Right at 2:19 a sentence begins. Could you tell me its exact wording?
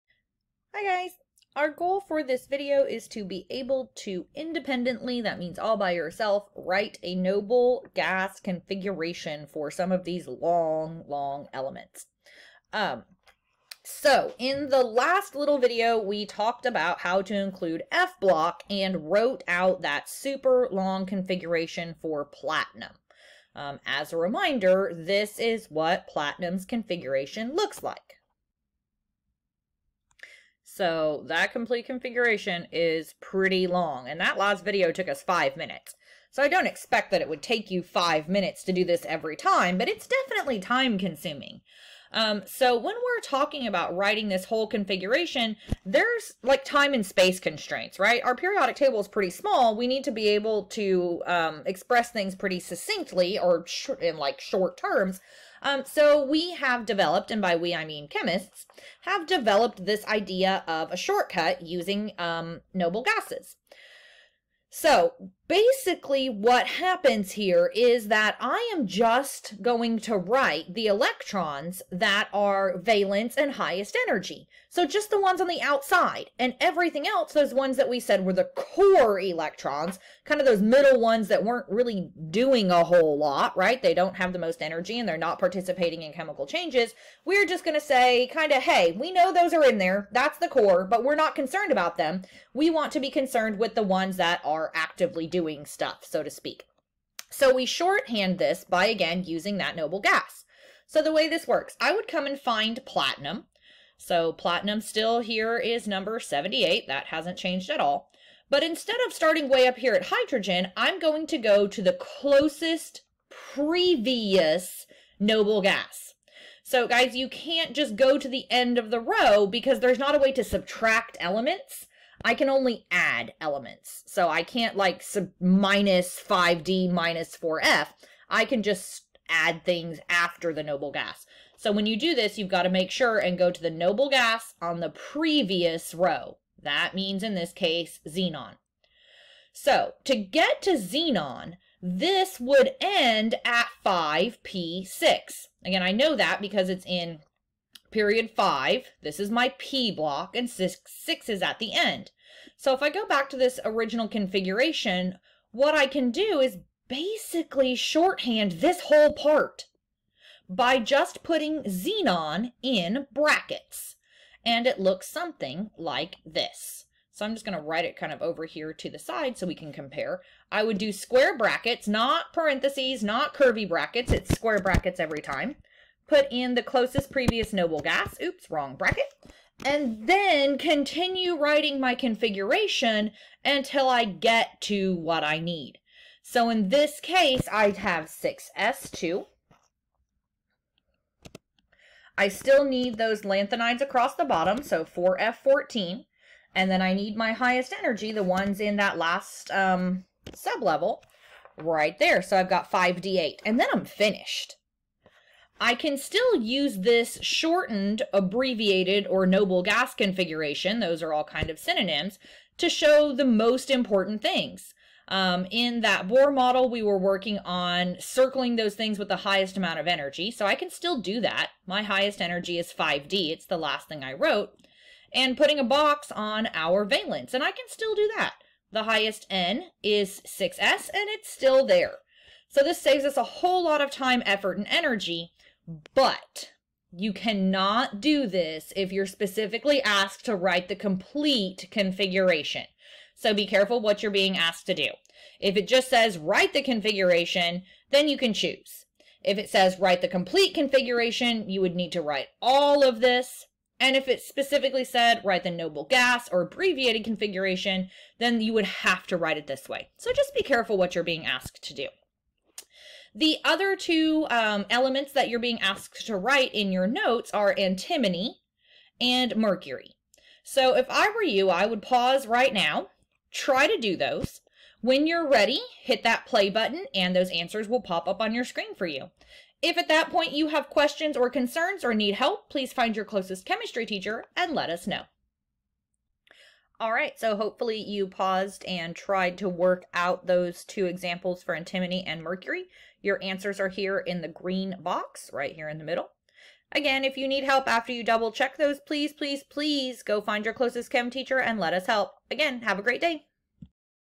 So to get to xenon, this would end at 5p6.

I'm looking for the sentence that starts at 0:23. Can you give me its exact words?
Um, as a reminder, this is what platinum's configuration looks like.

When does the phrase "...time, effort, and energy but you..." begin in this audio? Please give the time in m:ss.
3:53.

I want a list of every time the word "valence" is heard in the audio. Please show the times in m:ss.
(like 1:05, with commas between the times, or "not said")
1:12, 3:46.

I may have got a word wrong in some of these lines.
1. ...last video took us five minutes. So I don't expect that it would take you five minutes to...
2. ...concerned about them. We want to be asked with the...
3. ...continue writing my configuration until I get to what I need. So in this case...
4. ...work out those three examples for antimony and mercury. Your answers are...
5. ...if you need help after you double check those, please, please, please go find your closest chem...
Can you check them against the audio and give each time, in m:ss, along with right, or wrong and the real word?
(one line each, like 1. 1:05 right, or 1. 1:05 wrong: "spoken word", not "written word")
1. 0:34 right
2. 1:31 wrong: "concerned", not "asked"
3. 3:00 right
4. 4:49 wrong: "two", not "three"
5. 4:57 right.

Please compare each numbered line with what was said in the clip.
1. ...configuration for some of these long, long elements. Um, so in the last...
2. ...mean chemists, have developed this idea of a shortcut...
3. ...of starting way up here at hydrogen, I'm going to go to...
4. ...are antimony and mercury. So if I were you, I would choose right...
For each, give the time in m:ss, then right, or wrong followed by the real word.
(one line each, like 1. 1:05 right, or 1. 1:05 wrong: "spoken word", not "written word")
1. 0:08 right
2. 0:57 right
3. 1:49 right
4. 4:27 wrong: "pause", not "choose".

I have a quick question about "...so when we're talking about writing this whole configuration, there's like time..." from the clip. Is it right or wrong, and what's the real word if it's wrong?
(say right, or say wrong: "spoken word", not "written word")
right.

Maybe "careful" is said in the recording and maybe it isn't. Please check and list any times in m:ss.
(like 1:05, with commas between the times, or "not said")
4:03, 4:20.